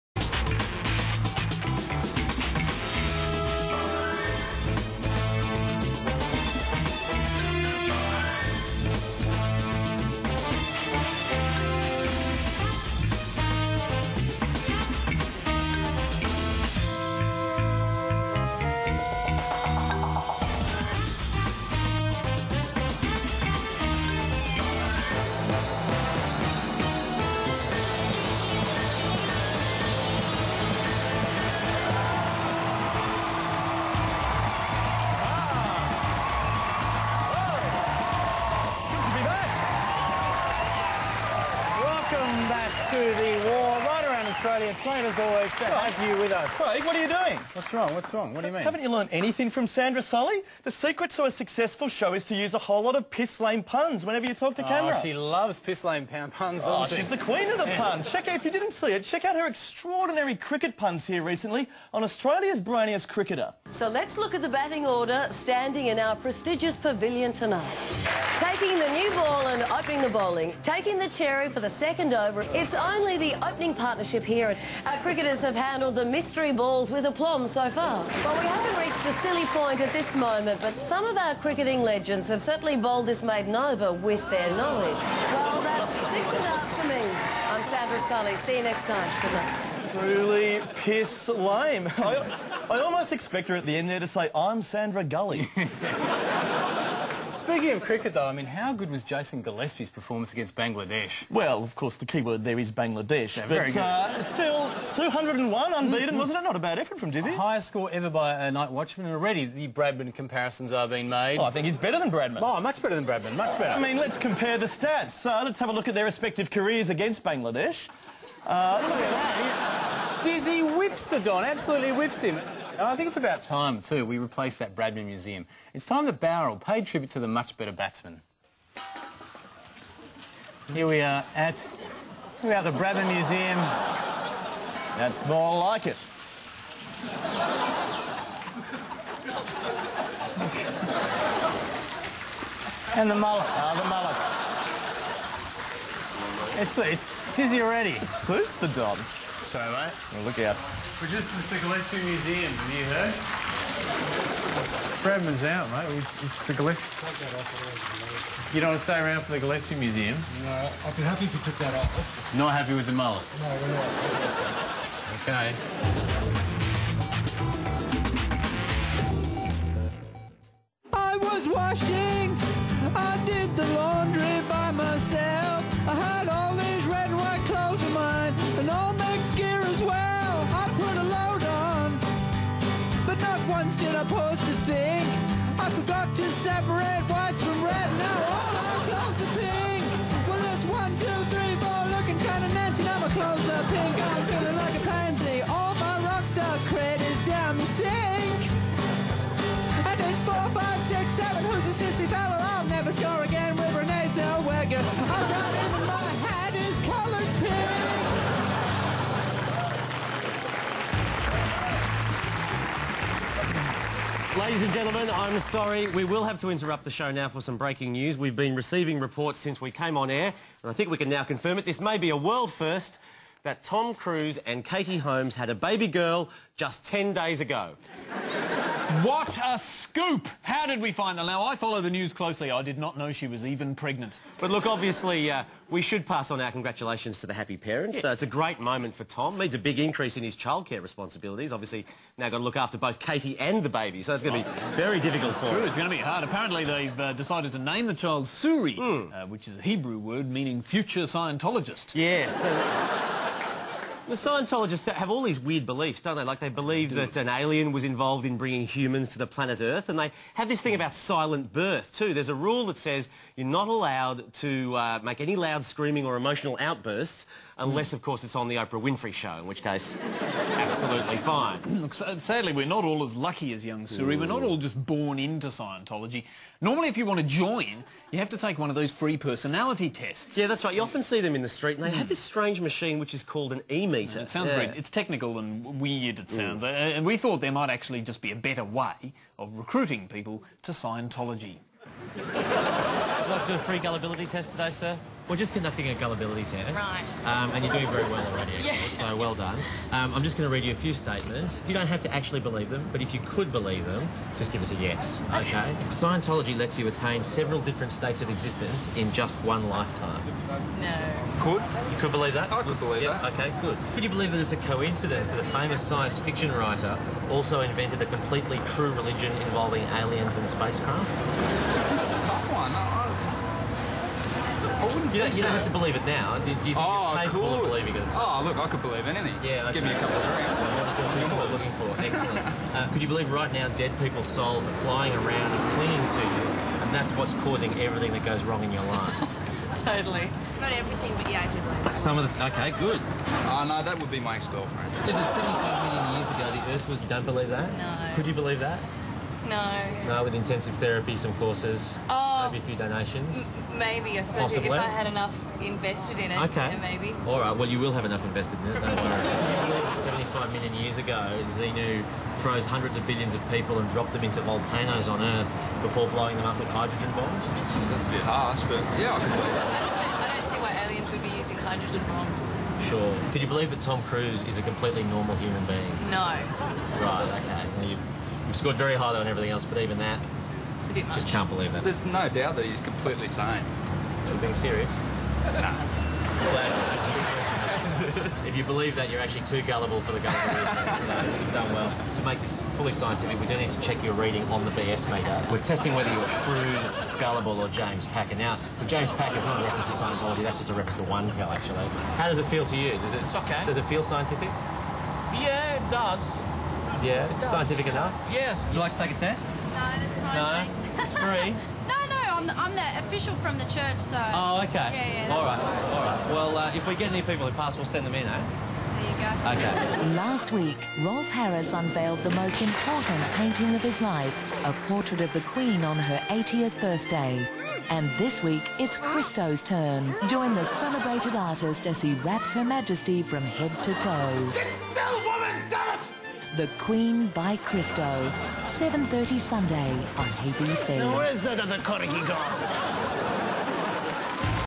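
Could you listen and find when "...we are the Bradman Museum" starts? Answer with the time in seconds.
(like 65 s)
132 s.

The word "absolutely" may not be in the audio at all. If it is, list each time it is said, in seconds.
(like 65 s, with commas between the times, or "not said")
121 s, 270 s.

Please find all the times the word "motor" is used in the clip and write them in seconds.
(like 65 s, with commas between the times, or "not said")
not said.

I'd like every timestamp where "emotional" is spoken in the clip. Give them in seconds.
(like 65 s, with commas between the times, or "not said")
266 s.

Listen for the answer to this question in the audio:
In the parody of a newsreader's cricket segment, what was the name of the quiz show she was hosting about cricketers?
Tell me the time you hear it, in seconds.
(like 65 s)
62 s.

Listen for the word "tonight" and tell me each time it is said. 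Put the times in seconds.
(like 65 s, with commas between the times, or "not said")
67 s.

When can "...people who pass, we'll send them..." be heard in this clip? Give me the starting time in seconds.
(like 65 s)
417 s.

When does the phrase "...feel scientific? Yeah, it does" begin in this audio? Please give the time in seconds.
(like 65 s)
403 s.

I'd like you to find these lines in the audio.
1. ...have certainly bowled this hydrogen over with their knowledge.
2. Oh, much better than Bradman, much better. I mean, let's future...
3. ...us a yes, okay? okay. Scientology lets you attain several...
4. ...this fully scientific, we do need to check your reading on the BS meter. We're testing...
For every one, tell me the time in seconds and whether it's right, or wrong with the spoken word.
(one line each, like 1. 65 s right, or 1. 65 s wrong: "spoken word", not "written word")
1. 82 s wrong: "maiden", not "hydrogen"
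2. 112 s wrong: "compare", not "future"
3. 304 s right
4. 392 s right.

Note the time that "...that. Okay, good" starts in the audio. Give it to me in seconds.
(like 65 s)
313 s.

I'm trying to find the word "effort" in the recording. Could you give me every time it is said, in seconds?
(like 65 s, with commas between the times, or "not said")
106 s.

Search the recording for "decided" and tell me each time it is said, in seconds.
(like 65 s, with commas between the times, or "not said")
247 s.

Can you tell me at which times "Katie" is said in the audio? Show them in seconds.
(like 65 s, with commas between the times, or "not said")
224 s, 242 s.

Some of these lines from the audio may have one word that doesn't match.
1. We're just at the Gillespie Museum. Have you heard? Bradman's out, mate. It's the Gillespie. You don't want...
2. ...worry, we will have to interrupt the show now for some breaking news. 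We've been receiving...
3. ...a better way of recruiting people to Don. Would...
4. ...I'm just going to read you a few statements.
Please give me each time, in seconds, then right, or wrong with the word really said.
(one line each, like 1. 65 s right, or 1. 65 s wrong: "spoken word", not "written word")
1. 151 s right
2. 215 s wrong: "sorry", not "worry"
3. 288 s wrong: "Scientology", not "Don"
4. 300 s right.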